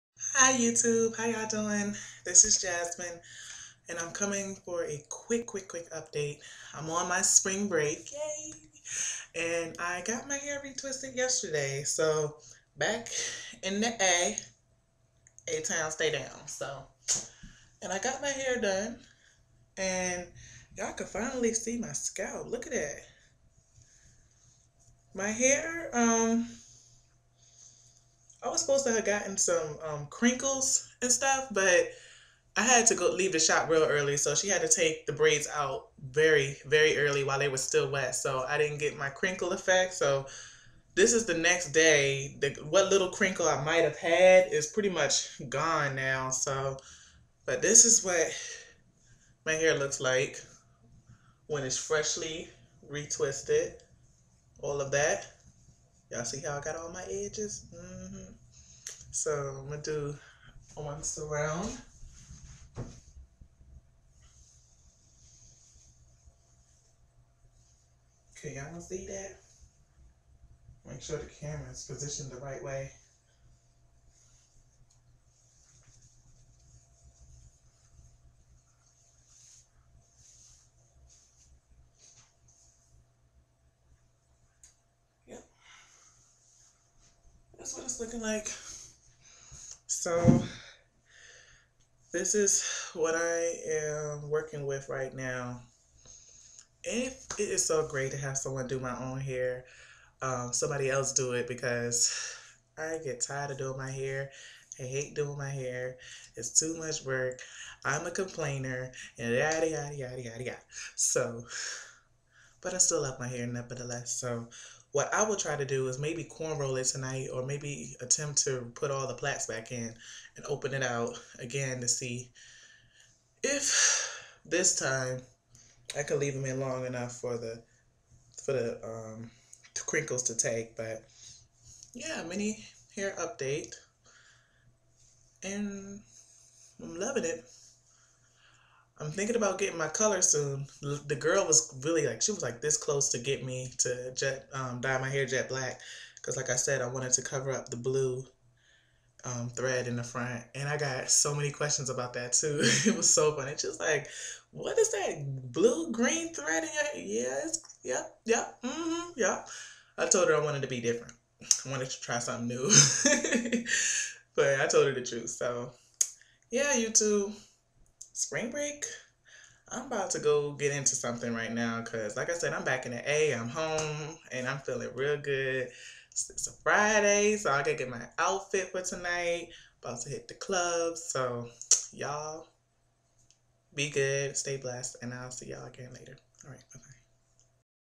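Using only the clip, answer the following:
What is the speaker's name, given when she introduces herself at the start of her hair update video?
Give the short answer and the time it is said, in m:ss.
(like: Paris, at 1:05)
Jasmine, at 0:02.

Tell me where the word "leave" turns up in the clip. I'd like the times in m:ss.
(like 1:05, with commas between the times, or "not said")
0:33, 2:06.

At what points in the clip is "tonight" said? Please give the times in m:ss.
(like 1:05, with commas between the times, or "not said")
1:56, 2:58.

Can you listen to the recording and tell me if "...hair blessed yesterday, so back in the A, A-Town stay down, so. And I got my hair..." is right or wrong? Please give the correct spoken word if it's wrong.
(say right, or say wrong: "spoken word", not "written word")
wrong: "retwisted", not "blessed".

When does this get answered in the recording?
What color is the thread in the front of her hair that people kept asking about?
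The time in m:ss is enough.
2:35.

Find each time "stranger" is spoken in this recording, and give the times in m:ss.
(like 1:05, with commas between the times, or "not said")
not said.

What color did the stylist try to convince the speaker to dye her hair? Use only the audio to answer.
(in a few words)
jet black.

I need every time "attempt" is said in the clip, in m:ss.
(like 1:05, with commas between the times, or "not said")
1:58.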